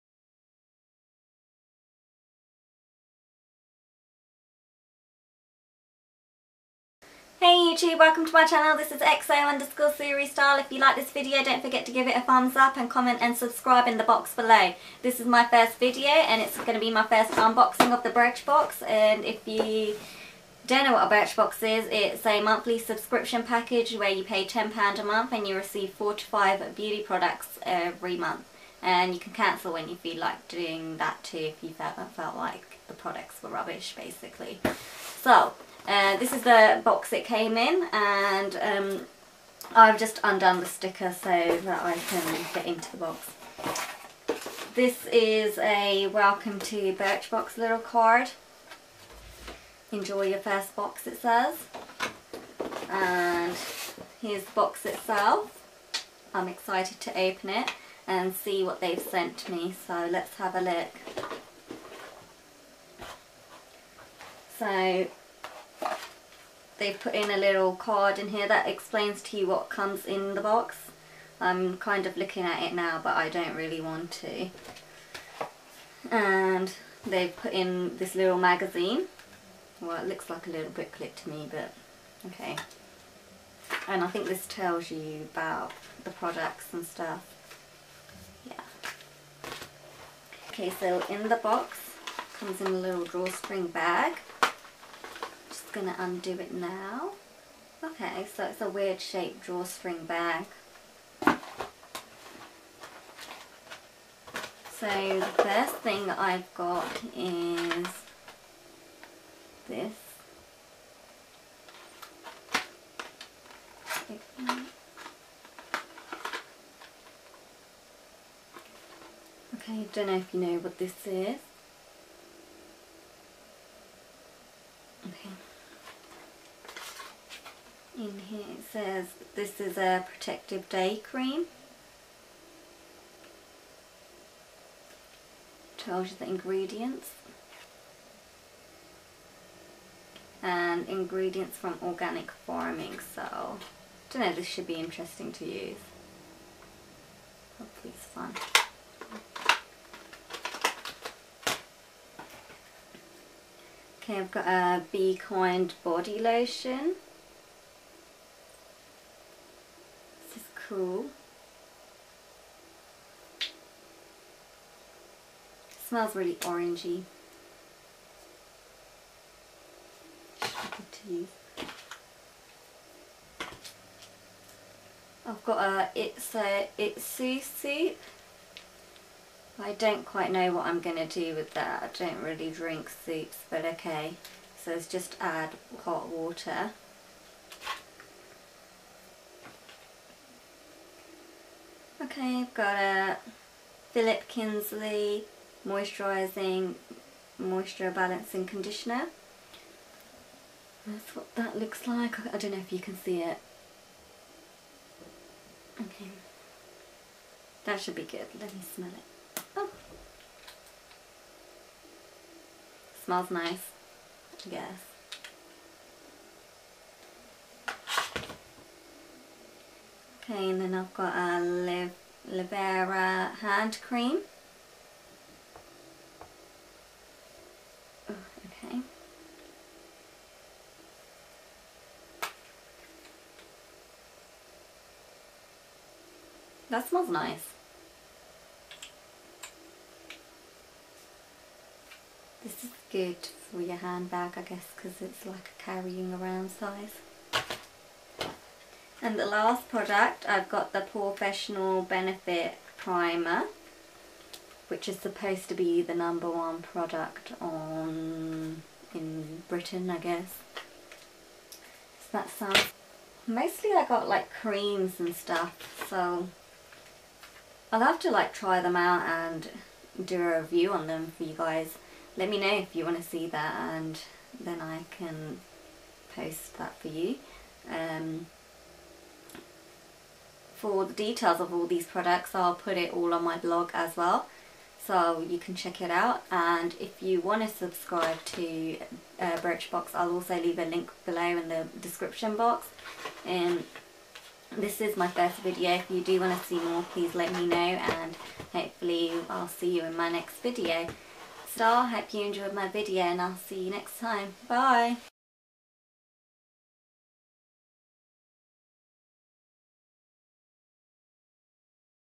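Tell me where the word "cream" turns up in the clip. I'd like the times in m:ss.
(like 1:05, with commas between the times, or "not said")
2:11, 3:43, 4:24.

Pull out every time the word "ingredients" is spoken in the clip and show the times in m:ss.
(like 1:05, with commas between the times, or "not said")
2:16, 2:20.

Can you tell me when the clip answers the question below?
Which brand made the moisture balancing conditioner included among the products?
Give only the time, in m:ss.
3:13.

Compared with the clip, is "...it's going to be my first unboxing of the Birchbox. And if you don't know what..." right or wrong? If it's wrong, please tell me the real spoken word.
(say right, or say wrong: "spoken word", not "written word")
right.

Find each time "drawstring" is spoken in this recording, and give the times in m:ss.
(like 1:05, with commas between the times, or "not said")
1:33, 1:39.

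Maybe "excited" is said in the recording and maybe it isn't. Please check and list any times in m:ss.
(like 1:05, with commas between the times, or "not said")
0:56.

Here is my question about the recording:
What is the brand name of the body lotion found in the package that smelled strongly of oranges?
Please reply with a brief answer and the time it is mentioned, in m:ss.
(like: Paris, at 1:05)
Beekind, at 2:34.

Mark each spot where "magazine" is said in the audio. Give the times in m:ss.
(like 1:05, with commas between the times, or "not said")
1:18.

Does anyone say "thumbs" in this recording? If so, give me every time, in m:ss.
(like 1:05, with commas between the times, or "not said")
0:12.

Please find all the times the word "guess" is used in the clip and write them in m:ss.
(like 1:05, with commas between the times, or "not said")
3:34, 4:04, 4:19.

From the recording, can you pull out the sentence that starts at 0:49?
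Enjoy your first box it says.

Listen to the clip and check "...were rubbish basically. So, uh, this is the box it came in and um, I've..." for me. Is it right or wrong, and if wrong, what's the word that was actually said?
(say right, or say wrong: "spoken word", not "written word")
right.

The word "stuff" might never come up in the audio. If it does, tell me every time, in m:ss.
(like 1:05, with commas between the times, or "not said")
1:26, 4:25.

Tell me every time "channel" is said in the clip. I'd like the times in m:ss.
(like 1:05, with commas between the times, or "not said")
0:08.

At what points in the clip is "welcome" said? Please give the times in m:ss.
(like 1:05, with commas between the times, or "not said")
0:07, 0:46.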